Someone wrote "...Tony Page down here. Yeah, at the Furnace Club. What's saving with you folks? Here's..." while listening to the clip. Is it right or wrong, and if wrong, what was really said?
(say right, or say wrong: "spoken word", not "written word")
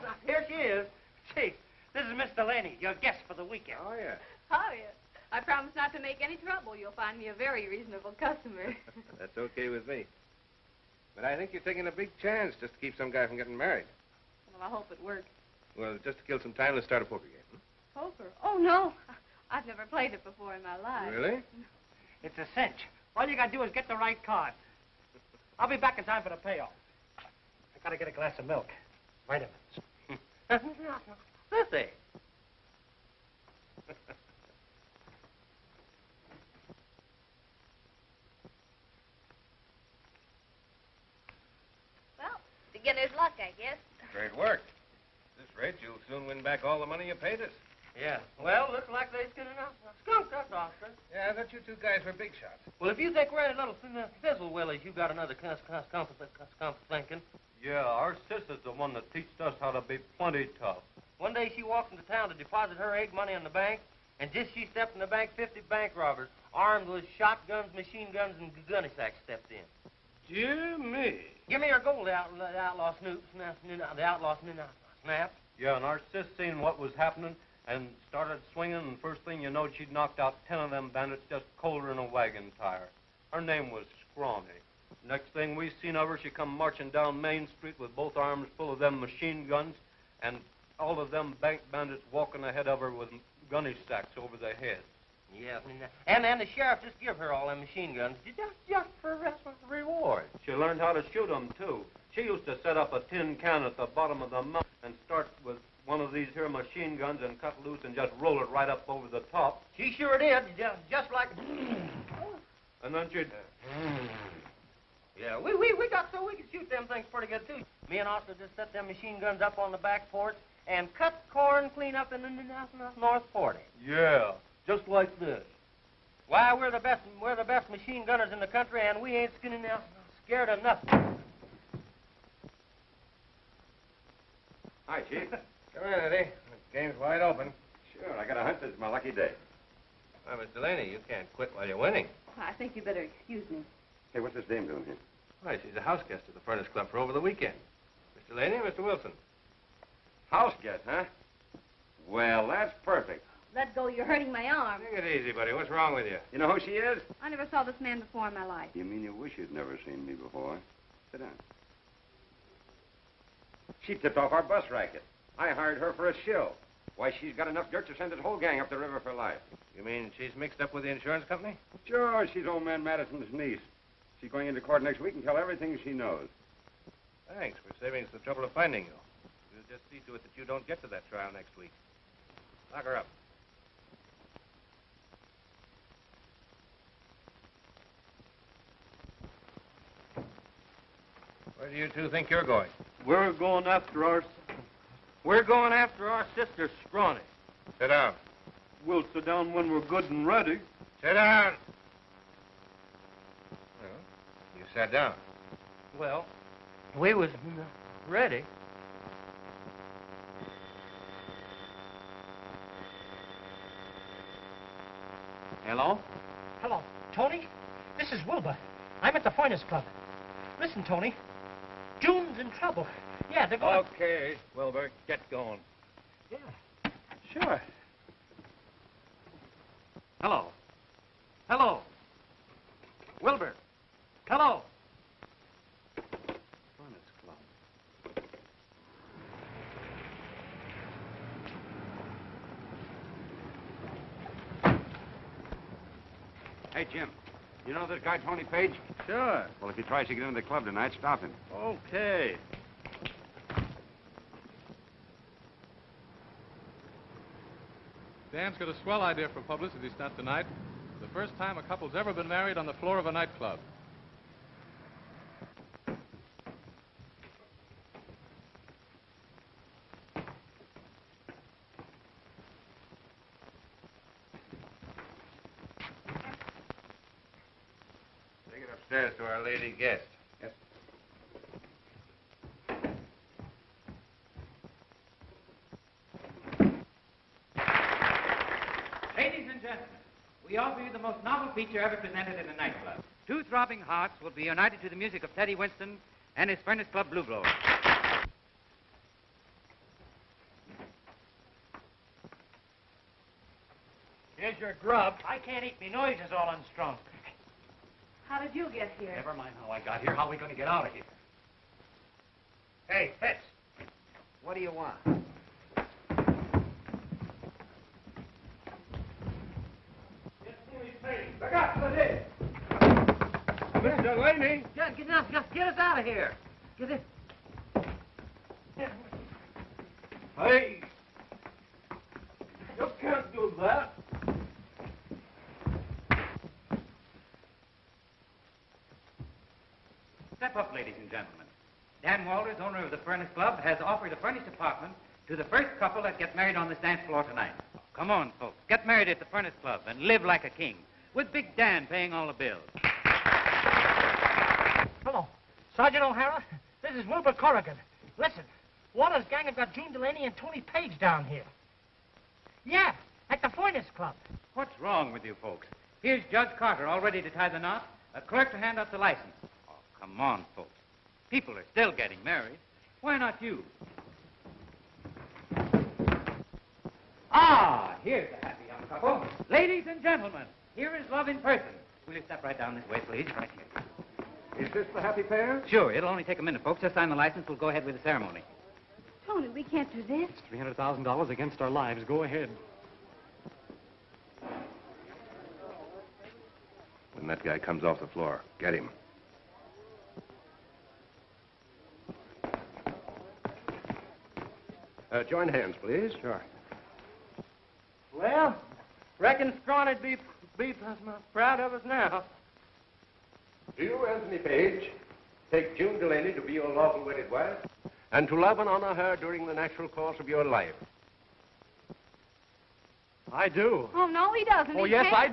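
wrong: "wrong", not "saving".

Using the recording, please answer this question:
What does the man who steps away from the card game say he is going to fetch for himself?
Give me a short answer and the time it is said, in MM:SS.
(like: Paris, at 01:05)
A glass of milk, at 00:28.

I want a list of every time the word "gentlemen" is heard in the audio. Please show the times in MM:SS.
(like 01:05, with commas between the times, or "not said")
05:41, 06:20.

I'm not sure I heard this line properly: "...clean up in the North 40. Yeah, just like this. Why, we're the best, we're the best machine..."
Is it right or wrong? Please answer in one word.
right.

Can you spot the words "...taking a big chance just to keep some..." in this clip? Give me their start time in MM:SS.
00:11.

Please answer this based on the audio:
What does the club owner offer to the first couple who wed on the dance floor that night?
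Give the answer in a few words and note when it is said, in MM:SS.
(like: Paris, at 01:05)
A furnished apartment, at 05:44.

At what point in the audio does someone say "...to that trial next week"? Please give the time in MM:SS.
03:00.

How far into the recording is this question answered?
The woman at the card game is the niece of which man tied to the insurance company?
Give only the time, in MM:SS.
02:52.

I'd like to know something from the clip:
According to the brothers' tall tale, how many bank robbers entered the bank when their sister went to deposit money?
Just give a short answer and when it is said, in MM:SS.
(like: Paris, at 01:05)
50, at 01:05.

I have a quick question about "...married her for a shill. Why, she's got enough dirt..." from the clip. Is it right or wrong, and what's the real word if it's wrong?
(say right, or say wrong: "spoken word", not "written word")
wrong: "hired", not "married".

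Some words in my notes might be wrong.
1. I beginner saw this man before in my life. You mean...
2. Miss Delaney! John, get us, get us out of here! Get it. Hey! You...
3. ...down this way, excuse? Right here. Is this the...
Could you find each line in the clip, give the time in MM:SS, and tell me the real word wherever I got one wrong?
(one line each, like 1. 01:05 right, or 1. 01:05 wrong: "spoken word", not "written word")
1. 02:37 wrong: "never", not "beginner"
2. 05:23 right
3. 06:22 wrong: "please", not "excuse".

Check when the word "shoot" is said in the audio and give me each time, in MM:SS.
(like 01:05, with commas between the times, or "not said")
01:41, 01:56.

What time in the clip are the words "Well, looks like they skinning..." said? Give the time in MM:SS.
00:48.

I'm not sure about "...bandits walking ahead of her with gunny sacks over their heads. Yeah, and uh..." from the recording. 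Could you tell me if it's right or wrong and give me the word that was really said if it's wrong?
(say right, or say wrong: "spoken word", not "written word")
right.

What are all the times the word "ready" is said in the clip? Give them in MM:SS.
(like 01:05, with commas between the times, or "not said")
03:20, 03:28, 06:07.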